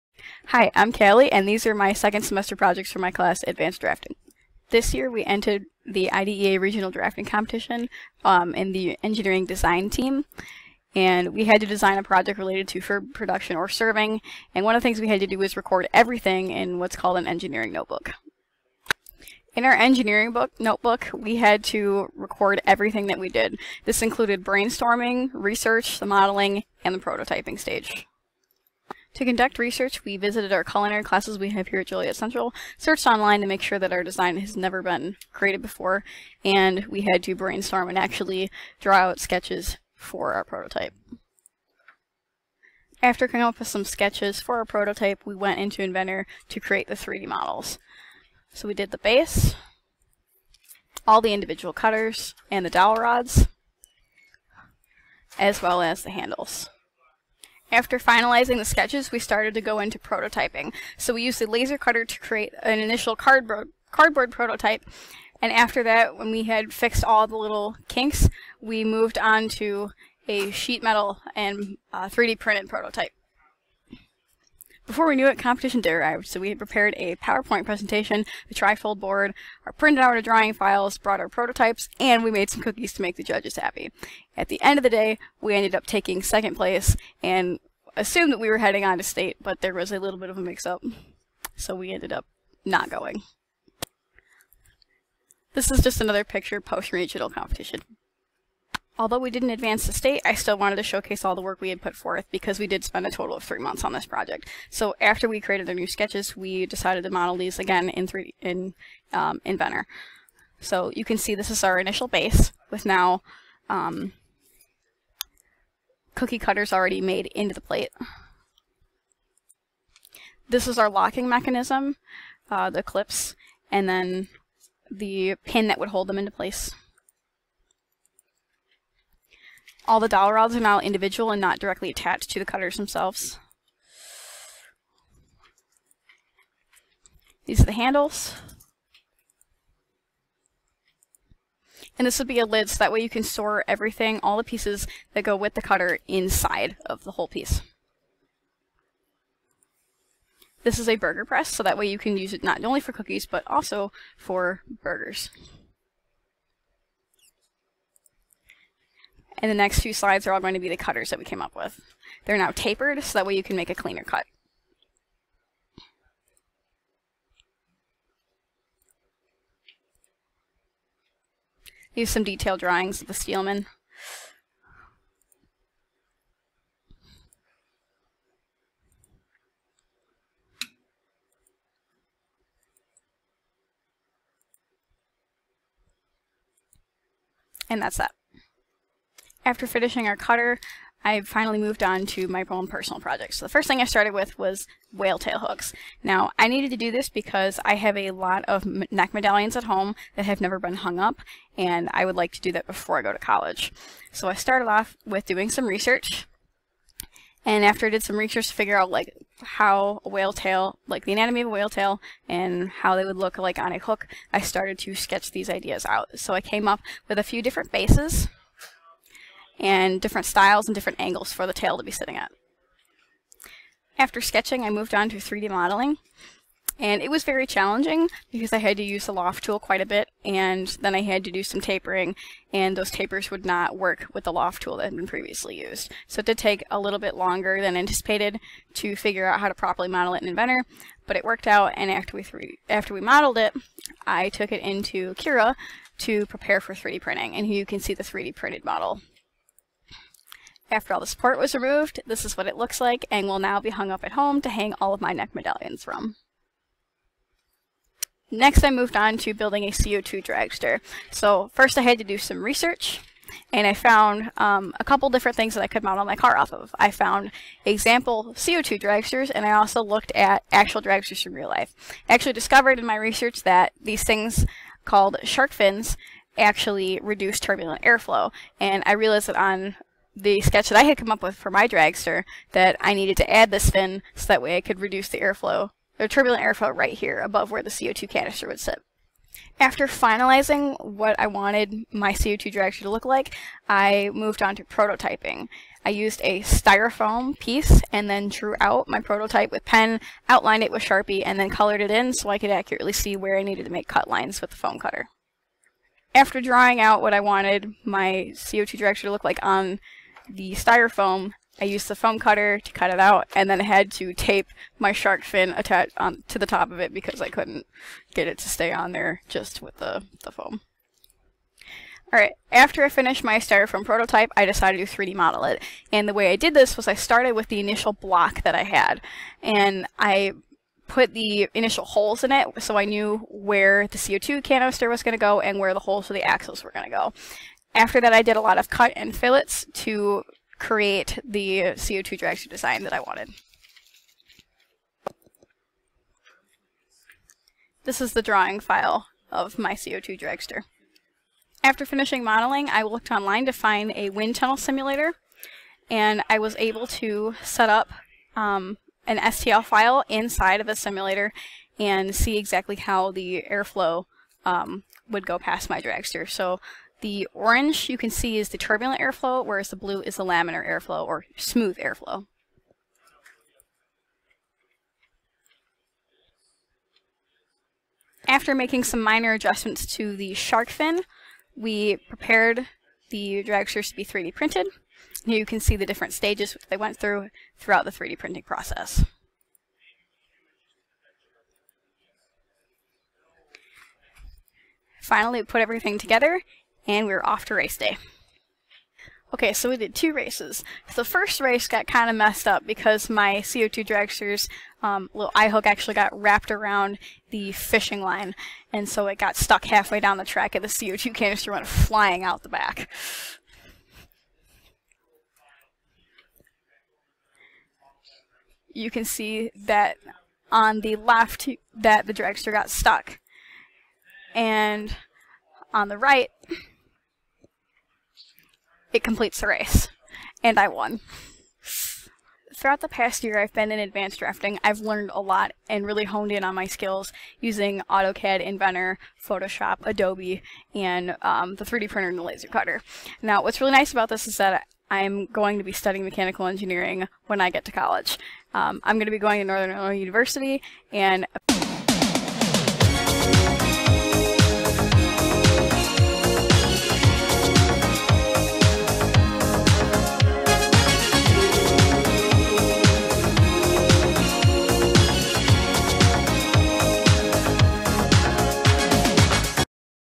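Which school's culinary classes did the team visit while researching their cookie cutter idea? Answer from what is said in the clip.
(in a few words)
Joliet Central.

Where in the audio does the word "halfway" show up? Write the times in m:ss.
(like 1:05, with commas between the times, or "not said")
6:49.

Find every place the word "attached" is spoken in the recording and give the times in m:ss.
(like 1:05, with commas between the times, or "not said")
2:11, 5:15.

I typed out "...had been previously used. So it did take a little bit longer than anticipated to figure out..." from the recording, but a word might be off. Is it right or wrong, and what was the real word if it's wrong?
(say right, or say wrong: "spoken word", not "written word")
right.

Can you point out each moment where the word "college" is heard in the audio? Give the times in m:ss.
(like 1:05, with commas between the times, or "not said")
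3:23, 7:27.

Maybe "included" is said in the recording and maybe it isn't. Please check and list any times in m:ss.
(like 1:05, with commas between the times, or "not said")
0:24.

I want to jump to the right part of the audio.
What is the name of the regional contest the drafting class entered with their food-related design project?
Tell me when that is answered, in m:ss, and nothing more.
0:06.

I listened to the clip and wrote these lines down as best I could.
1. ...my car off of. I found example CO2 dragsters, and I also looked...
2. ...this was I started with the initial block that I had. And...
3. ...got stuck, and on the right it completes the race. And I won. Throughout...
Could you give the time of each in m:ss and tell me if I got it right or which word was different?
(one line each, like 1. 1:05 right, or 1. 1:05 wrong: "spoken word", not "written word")
1. 4:26 right
2. 5:26 right
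3. 7:02 right.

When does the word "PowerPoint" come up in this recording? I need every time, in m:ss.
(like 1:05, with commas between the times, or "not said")
1:17.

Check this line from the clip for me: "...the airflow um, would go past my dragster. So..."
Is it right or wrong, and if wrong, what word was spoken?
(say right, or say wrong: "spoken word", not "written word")
right.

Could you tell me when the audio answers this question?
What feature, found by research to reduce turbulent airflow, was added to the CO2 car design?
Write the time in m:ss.
4:35.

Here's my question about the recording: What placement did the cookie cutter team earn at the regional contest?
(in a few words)
second place.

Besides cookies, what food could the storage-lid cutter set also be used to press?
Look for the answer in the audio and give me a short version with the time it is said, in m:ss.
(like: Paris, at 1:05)
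burgers, at 2:34.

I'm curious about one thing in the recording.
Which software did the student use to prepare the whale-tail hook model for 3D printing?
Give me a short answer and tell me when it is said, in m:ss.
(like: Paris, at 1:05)
Cura, at 4:05.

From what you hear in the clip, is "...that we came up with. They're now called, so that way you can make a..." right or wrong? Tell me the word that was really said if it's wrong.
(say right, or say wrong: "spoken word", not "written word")
wrong: "tapered", not "called".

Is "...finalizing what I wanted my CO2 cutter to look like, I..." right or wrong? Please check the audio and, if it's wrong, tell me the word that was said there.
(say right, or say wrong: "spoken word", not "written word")
wrong: "dragster", not "cutter".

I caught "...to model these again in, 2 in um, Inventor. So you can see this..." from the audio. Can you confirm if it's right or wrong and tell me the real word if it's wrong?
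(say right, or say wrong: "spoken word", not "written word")
wrong: "3", not "2".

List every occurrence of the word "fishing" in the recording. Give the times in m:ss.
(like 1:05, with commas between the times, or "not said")
6:47.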